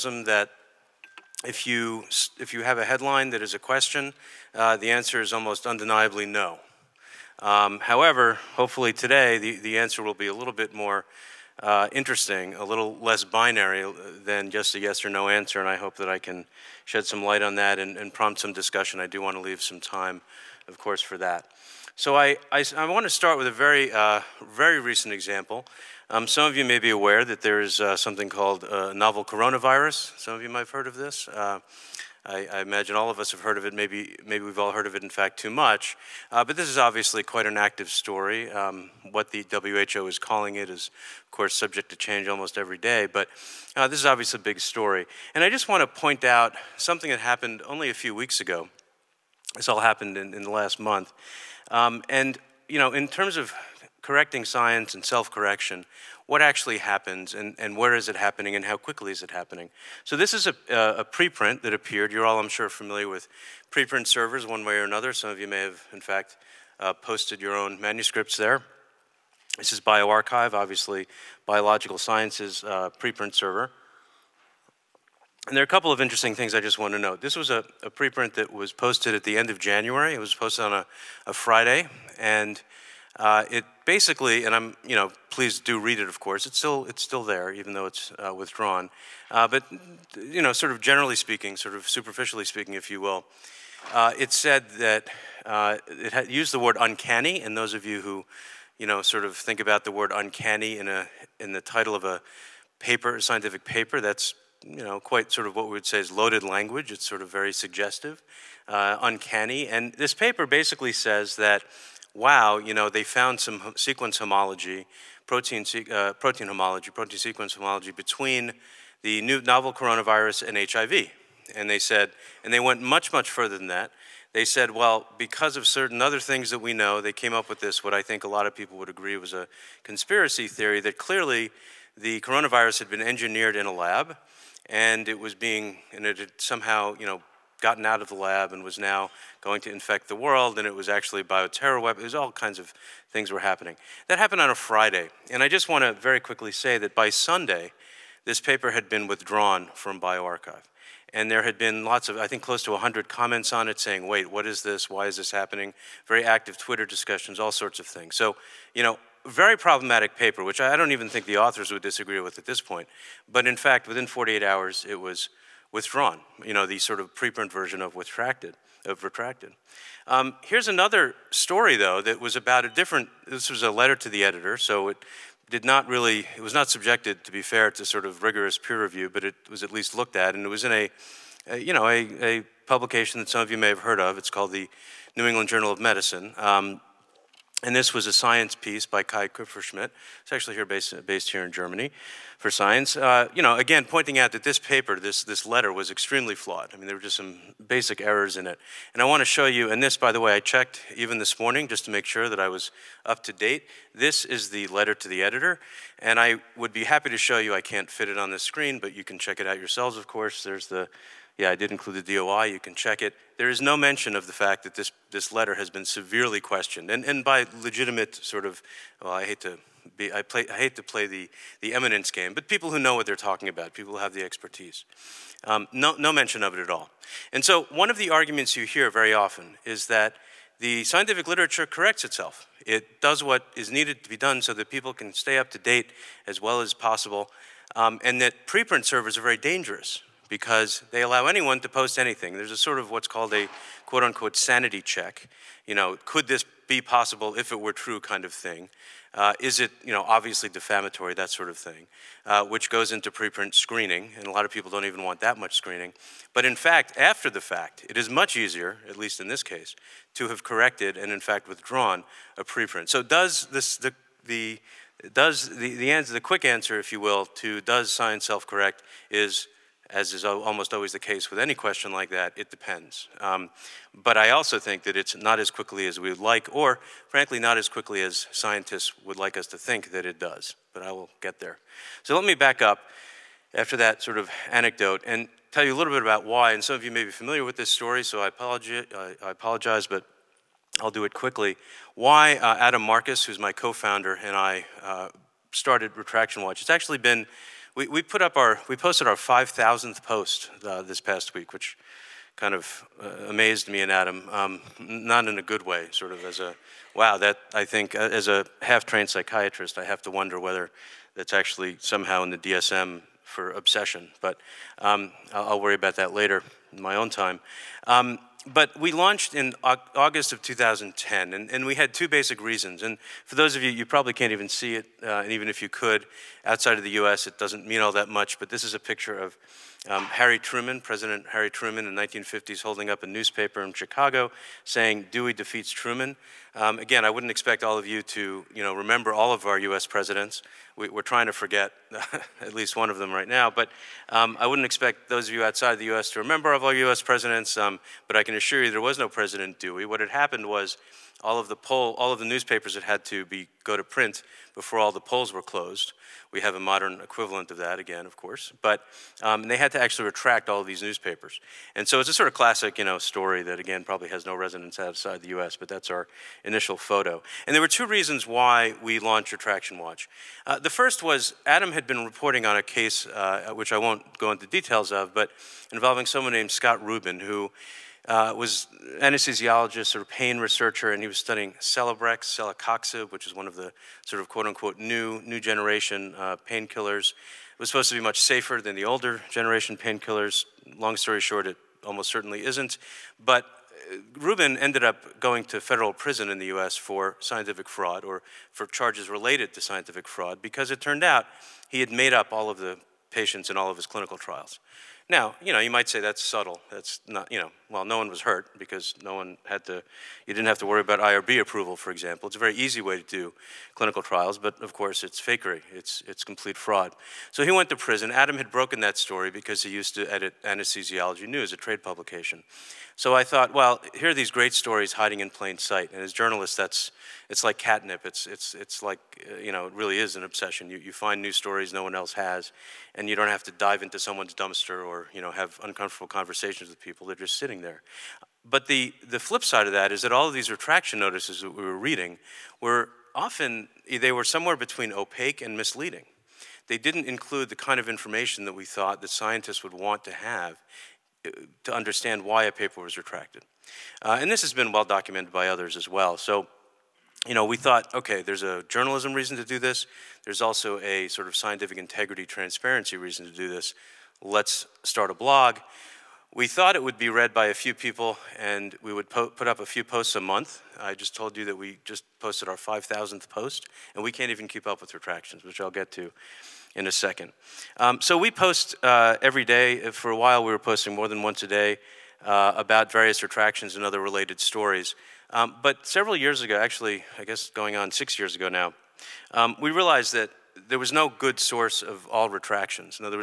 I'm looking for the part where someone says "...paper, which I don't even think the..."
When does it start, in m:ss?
2:40.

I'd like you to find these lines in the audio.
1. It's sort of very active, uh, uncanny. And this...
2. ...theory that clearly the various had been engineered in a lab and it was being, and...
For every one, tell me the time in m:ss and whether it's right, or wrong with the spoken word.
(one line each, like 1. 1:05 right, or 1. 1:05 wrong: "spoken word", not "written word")
1. 1:46 wrong: "suggestive", not "active"
2. 2:10 wrong: "coronavirus", not "various".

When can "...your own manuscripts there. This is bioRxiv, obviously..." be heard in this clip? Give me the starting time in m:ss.
1:07.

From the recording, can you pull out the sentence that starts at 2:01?
And they said, and they went much, much further than that.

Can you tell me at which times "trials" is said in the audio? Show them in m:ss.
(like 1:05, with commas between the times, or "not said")
6:44, 6:54.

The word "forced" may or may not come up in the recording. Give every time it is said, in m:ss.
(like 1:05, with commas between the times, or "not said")
not said.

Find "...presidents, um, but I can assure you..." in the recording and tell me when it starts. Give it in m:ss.
5:47.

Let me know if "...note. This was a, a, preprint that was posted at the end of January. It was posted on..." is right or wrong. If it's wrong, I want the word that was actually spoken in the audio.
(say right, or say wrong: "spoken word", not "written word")
right.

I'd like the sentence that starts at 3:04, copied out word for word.
It's called the New England Journal of Medicine.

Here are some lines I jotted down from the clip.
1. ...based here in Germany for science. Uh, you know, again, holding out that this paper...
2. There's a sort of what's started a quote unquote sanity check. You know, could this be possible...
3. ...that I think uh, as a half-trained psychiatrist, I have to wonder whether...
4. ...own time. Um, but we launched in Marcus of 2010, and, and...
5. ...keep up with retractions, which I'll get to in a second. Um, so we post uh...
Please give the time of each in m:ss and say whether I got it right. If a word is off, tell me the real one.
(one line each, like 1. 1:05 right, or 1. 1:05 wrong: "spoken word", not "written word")
1. 3:11 wrong: "pointing", not "holding"
2. 4:02 wrong: "called", not "started"
3. 5:07 right
4. 5:16 wrong: "August", not "Marcus"
5. 7:54 right.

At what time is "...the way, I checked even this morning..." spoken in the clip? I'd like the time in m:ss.
3:20.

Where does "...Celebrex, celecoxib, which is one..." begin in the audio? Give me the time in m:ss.
6:21.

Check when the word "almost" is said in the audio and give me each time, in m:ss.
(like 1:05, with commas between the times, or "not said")
0:05, 0:42, 4:30, 6:31.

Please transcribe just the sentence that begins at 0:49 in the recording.
This all happened in, in the last month.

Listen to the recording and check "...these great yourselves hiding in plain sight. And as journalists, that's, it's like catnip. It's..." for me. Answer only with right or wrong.
wrong.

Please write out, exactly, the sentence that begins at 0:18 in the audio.
I do want to leave some time, of course, for that.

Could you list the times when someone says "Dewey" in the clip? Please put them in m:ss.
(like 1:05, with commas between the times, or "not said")
5:35, 5:49.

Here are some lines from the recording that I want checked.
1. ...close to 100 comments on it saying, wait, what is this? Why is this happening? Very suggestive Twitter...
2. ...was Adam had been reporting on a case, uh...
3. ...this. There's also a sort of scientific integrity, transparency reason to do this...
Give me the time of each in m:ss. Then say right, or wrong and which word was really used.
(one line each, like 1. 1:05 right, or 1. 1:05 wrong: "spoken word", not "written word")
1. 2:32 wrong: "active", not "suggestive"
2. 6:11 right
3. 7:39 right.